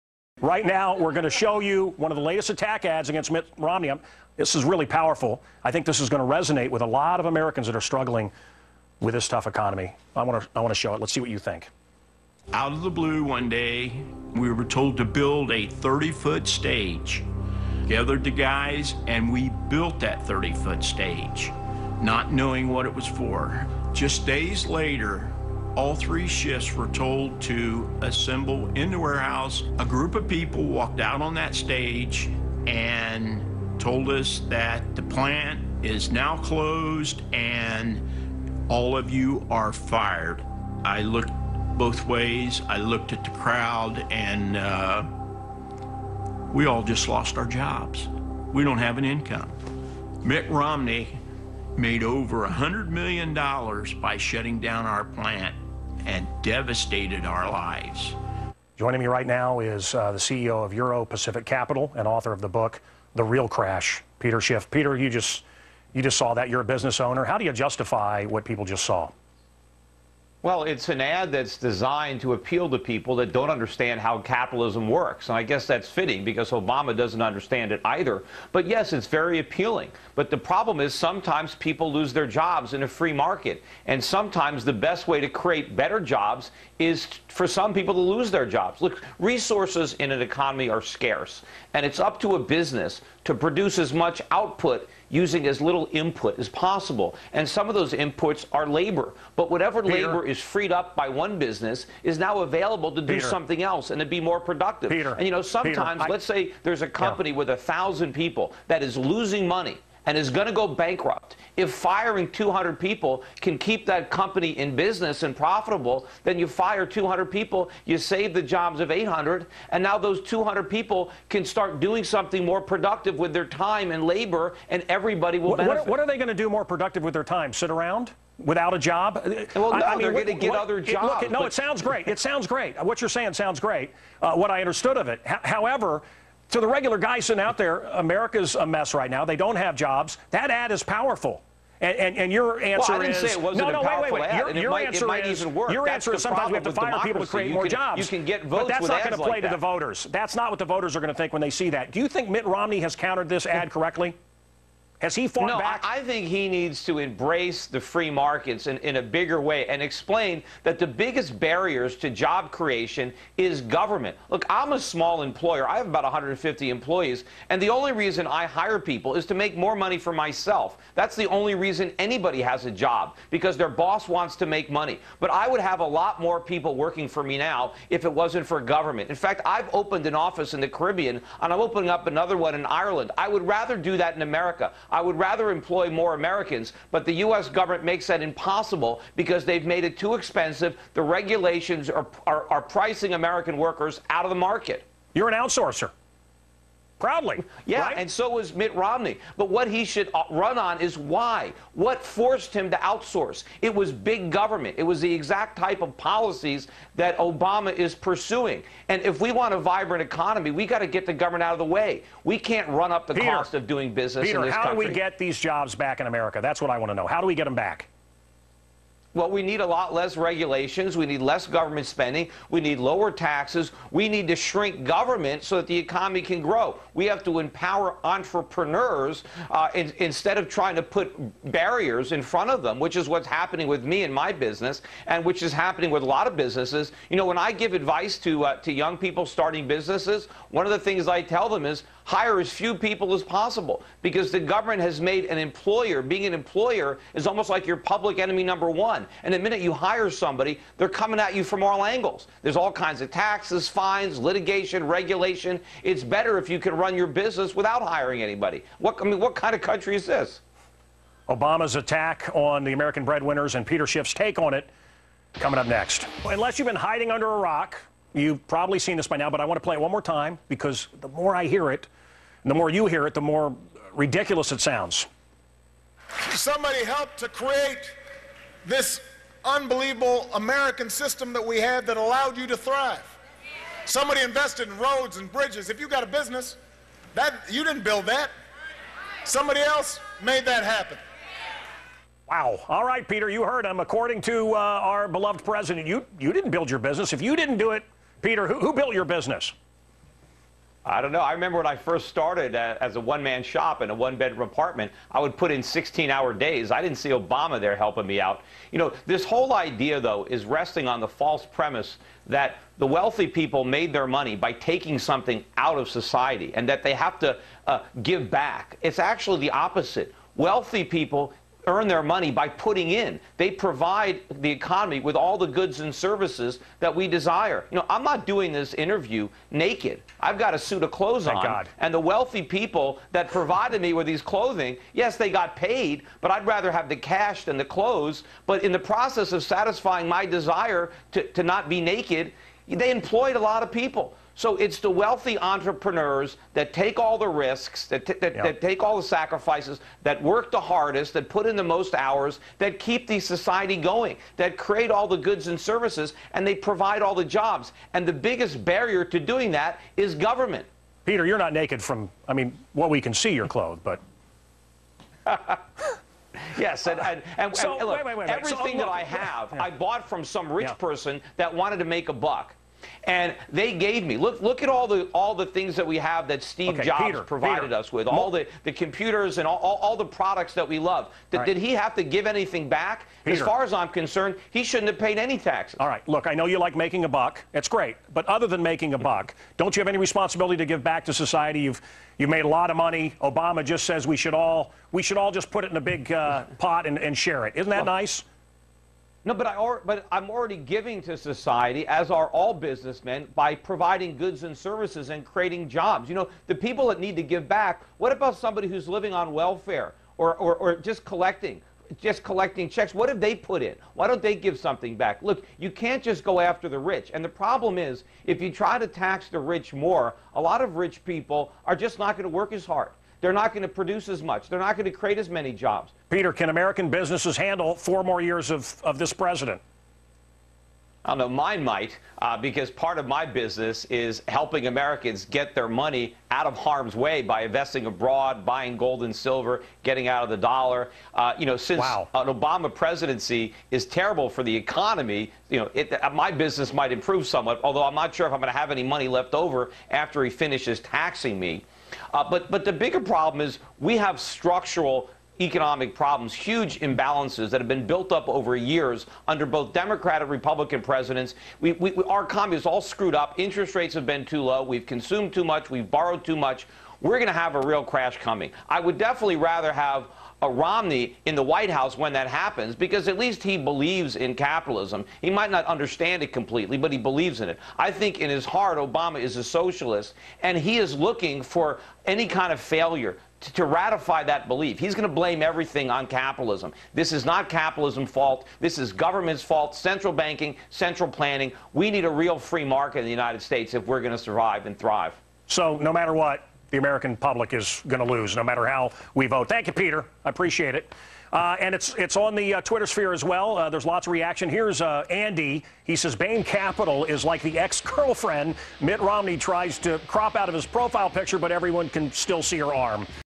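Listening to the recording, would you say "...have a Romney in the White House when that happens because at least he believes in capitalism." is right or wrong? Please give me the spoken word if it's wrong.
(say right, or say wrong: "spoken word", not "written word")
right.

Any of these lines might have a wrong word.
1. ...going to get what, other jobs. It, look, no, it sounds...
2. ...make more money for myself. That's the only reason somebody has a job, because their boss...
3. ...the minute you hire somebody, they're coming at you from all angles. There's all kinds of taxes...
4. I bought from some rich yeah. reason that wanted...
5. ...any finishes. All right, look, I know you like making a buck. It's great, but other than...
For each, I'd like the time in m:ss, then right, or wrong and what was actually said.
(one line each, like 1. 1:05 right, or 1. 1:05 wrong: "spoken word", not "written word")
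1. 2:10 right
2. 2:49 wrong: "anybody", not "somebody"
3. 4:09 right
4. 6:09 wrong: "person", not "reason"
5. 6:25 wrong: "taxes", not "finishes".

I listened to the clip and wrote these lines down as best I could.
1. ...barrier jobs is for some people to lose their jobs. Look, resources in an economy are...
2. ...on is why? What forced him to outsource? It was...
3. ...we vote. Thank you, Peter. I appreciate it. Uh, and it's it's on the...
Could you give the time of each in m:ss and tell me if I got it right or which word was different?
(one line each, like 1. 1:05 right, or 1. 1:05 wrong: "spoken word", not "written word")
1. 1:25 wrong: "better", not "barrier"
2. 3:20 right
3. 8:19 right.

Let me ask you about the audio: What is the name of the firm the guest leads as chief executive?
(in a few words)
Euro Pacific Capital.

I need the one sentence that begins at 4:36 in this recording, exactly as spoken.
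Somebody helped to create this unbelievable American system that we had that allowed you to thrive.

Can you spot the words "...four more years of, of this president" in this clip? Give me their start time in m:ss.
7:07.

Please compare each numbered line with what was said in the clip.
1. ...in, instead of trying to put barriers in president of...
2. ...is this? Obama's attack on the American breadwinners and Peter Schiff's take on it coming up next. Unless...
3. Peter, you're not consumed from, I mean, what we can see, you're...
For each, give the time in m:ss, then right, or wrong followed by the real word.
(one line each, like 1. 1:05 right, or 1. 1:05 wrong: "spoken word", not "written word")
1. 3:49 wrong: "front", not "president"
2. 4:19 right
3. 6:01 wrong: "naked", not "consumed".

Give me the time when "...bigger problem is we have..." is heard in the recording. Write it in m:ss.
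7:32.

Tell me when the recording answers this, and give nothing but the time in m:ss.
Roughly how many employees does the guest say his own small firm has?
2:46.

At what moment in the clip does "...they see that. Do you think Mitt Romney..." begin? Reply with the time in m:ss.
2:31.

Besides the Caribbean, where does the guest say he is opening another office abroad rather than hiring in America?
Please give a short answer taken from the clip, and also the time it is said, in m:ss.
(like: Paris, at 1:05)
Ireland, at 3:02.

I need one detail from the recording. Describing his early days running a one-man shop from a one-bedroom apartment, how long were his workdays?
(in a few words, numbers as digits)
16 hours.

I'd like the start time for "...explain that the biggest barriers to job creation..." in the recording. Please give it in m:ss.
2:39.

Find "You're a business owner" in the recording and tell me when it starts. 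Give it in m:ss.
1:06.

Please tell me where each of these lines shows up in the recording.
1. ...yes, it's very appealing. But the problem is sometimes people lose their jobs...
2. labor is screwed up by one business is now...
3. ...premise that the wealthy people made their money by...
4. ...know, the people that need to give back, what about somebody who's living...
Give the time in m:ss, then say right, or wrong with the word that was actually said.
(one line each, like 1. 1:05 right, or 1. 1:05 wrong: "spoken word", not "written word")
1. 1:18 right
2. 1:40 wrong: "freed", not "screwed"
3. 5:11 right
4. 6:46 right.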